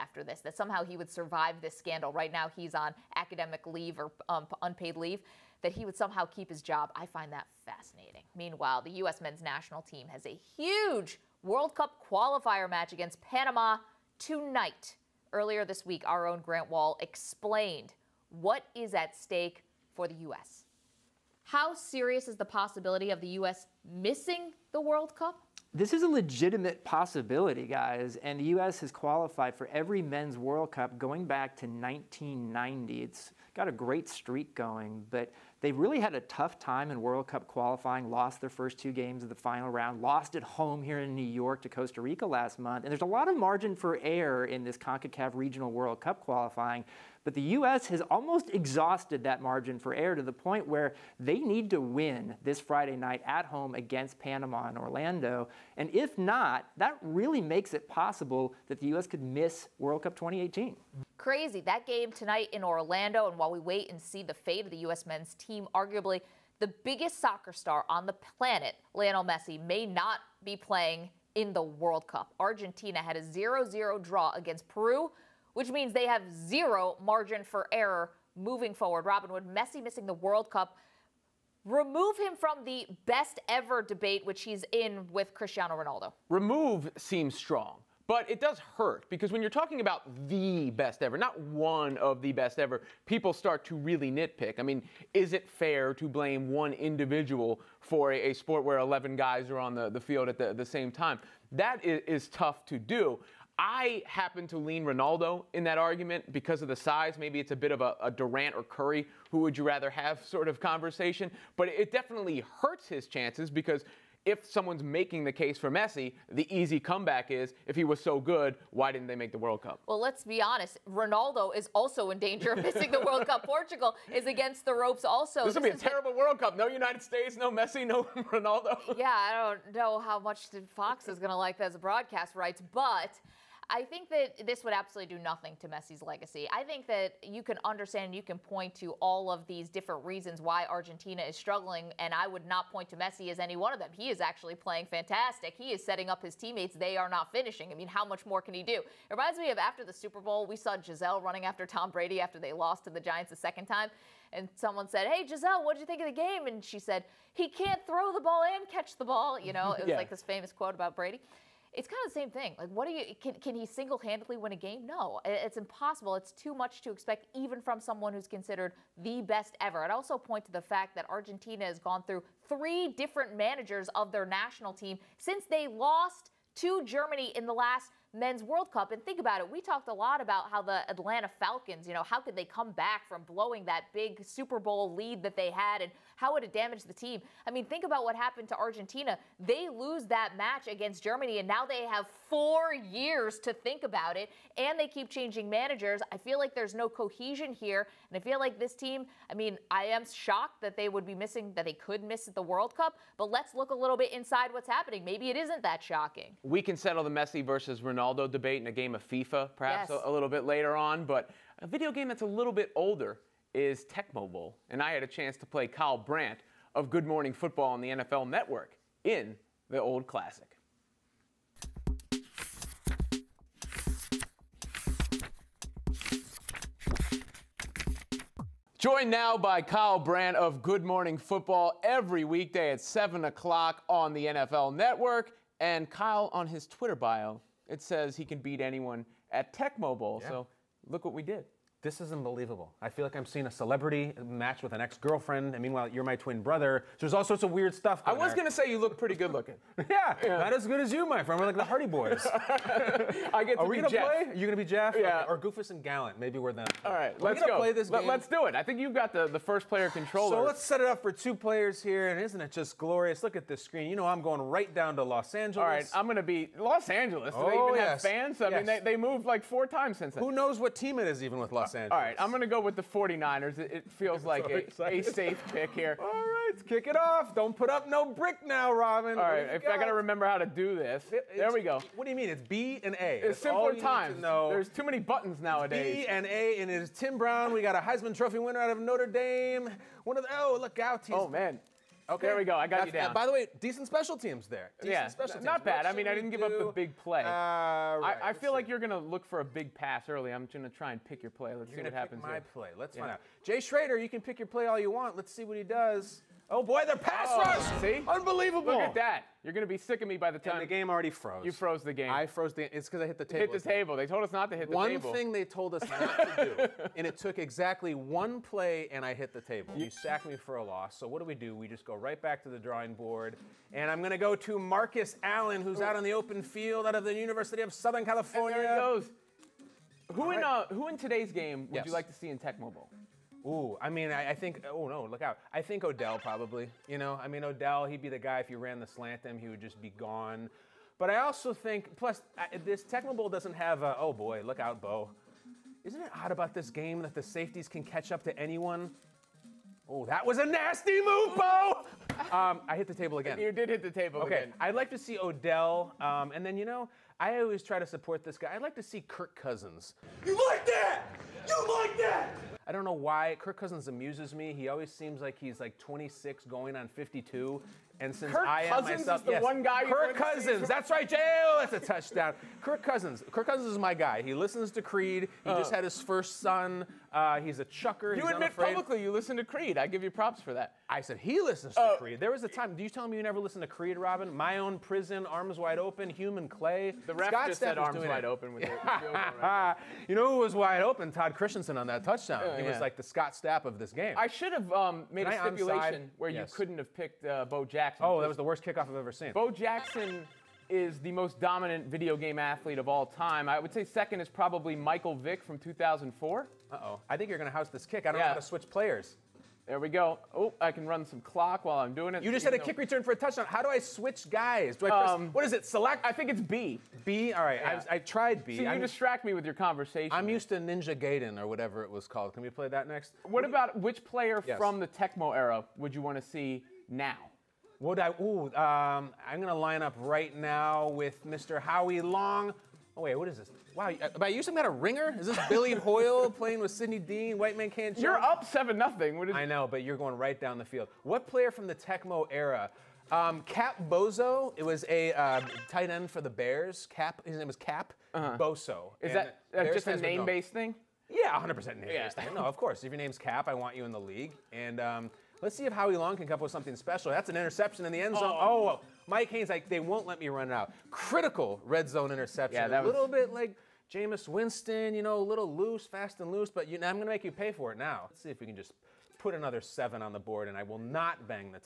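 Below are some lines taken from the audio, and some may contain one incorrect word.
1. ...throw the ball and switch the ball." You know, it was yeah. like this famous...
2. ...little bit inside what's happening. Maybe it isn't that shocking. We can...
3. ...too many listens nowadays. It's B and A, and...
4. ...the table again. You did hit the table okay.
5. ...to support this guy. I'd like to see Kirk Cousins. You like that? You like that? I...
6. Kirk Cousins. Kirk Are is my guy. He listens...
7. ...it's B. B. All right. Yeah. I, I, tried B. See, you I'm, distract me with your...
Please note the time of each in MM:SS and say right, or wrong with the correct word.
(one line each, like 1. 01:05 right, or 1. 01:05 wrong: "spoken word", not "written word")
1. 02:37 wrong: "catch", not "switch"
2. 03:23 right
3. 04:44 wrong: "buttons", not "listens"
4. 05:52 right
5. 05:57 right
6. 06:12 wrong: "Cousins", not "Are"
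7. 06:56 right.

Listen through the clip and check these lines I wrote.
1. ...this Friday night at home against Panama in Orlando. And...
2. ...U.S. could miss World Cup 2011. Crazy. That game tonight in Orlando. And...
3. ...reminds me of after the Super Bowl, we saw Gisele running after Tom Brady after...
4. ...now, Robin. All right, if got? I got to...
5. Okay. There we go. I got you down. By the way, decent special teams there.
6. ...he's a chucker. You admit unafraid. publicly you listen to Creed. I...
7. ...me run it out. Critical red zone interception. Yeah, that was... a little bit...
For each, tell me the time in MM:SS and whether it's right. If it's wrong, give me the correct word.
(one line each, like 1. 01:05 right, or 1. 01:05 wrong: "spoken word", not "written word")
1. 00:52 right
2. 00:58 wrong: "2018", not "2011"
3. 02:29 right
4. 04:38 right
5. 04:52 right
6. 06:17 right
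7. 07:40 right.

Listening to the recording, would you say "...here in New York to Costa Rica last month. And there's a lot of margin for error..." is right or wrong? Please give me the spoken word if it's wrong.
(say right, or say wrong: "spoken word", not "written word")
right.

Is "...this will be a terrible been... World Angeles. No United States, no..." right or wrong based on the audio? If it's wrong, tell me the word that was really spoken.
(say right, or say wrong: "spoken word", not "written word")
wrong: "Cup", not "Angeles".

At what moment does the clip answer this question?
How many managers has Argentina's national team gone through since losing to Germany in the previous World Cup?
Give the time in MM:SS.
02:52.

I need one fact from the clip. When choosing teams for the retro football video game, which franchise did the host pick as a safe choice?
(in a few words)
49ers.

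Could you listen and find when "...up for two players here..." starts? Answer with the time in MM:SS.
04:20.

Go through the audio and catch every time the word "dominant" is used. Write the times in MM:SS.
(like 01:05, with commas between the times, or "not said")
06:41.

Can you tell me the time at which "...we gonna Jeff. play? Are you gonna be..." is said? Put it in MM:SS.
04:13.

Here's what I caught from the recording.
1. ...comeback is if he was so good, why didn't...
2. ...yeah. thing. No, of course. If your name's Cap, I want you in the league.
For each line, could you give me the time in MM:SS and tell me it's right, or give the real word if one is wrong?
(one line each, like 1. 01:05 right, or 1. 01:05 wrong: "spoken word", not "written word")
1. 01:56 right
2. 07:31 right.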